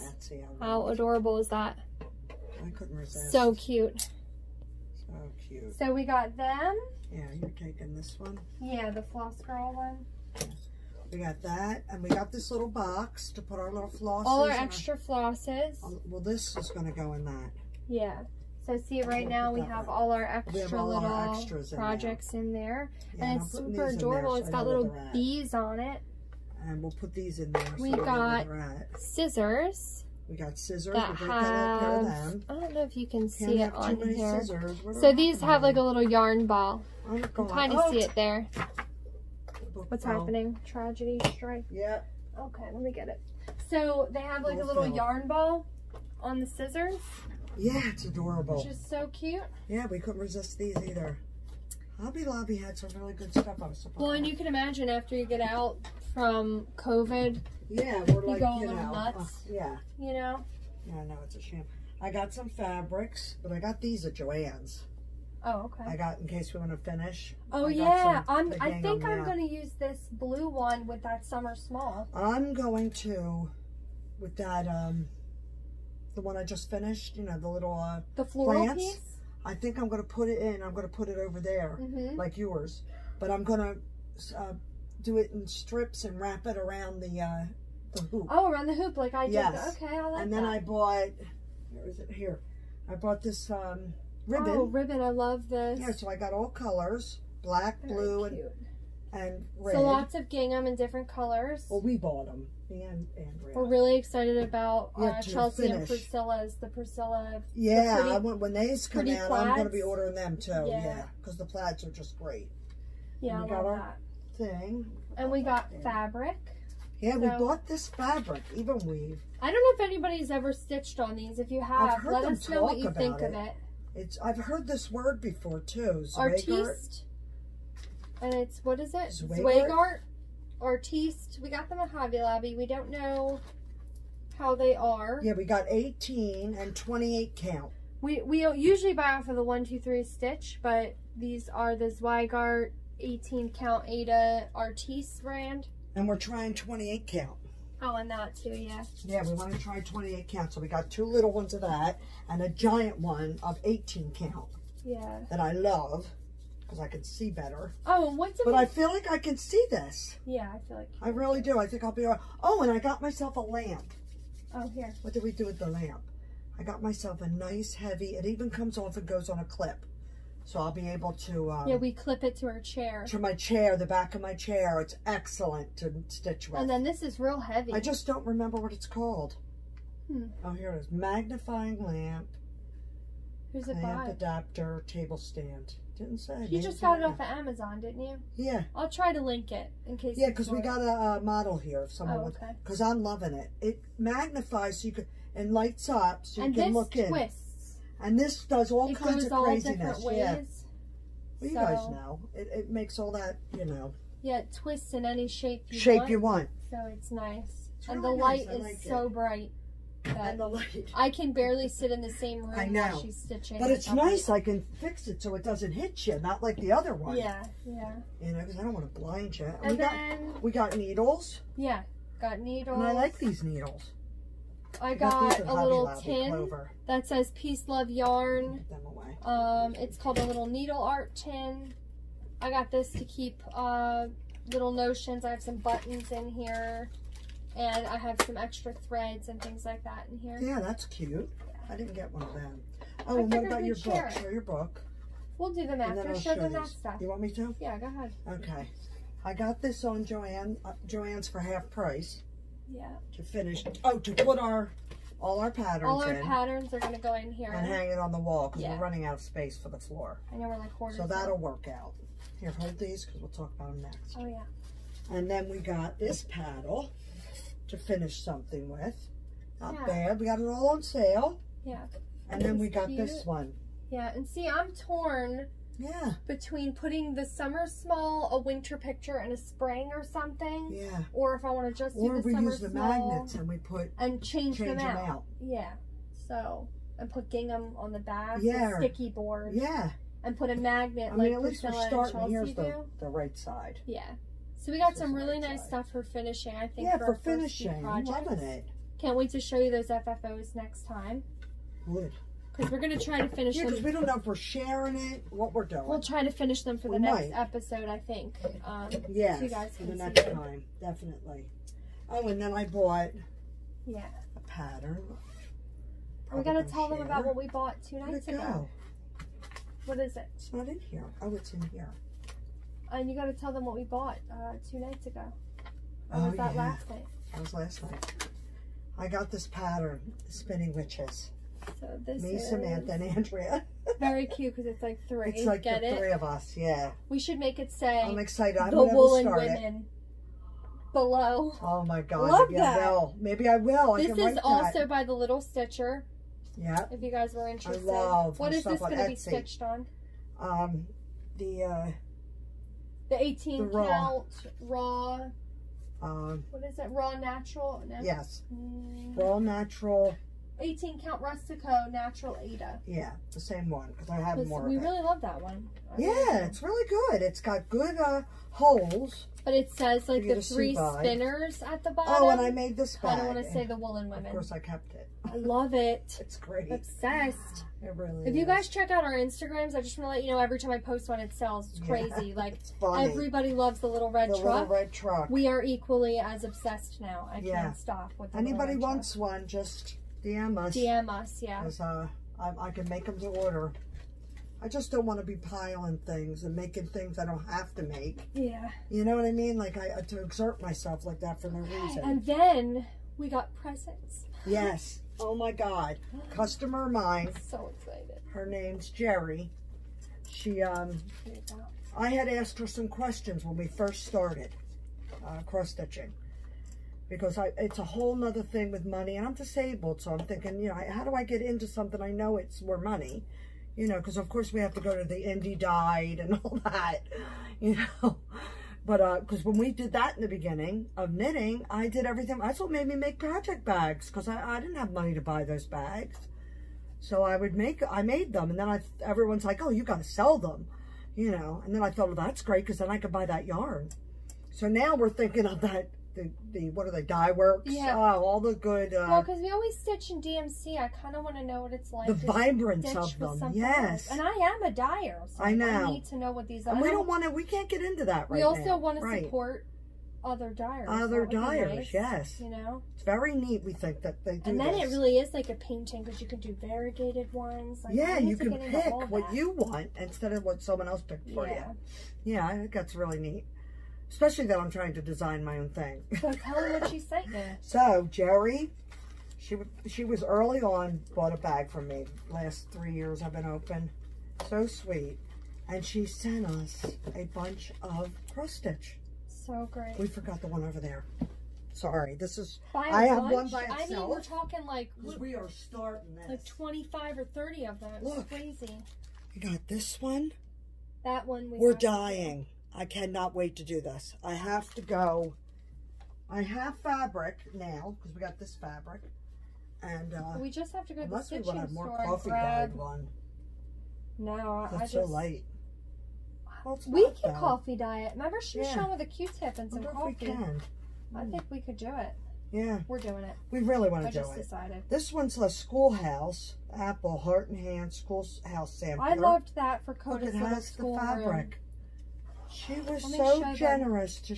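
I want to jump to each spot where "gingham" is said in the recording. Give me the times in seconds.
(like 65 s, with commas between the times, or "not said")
100 s, 287 s.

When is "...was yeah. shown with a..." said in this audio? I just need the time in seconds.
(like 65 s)
518 s.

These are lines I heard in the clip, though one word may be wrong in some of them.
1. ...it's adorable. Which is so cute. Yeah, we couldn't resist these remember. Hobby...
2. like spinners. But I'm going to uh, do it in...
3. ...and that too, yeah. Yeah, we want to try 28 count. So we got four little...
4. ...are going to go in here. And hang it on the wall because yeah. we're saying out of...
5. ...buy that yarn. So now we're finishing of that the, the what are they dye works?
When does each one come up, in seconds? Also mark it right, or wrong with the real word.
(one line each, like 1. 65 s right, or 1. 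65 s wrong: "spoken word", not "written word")
1. 47 s wrong: "either", not "remember"
2. 82 s wrong: "yours", not "spinners"
3. 147 s wrong: "two", not "four"
4. 256 s wrong: "running", not "saying"
5. 443 s wrong: "thinking", not "finishing".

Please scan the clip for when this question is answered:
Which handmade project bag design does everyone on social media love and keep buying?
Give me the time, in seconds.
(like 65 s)
384 s.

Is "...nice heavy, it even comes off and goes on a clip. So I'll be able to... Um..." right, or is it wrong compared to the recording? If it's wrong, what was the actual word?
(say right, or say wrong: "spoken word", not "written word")
right.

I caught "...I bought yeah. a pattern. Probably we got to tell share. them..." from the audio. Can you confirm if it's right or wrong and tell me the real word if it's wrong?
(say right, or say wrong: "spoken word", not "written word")
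right.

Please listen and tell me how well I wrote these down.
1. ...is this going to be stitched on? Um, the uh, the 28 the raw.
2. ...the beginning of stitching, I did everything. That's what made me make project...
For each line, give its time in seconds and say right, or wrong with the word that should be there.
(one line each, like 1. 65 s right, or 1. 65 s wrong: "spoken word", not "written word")
1. 348 s wrong: "18", not "28"
2. 430 s wrong: "knitting", not "stitching".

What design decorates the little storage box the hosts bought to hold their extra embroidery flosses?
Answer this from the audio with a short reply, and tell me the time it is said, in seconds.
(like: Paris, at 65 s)
Bees, at 25 s.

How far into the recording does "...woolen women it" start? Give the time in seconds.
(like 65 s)
338 s.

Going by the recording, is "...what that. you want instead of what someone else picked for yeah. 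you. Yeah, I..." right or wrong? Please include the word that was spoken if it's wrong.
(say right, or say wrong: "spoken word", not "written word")
right.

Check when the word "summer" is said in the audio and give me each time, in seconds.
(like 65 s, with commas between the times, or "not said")
71 s, 277 s, 282 s.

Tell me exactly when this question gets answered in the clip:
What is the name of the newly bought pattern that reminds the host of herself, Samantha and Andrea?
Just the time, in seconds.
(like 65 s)
330 s.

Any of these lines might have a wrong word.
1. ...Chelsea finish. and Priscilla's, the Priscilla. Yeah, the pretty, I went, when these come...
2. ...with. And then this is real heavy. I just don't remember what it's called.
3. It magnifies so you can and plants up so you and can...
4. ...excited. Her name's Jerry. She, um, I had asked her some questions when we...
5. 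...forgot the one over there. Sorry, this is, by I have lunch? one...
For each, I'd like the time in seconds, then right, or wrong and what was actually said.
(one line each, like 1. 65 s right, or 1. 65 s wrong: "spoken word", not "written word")
1. 105 s right
2. 176 s right
3. 193 s wrong: "lights", not "plants"
4. 407 s right
5. 490 s right.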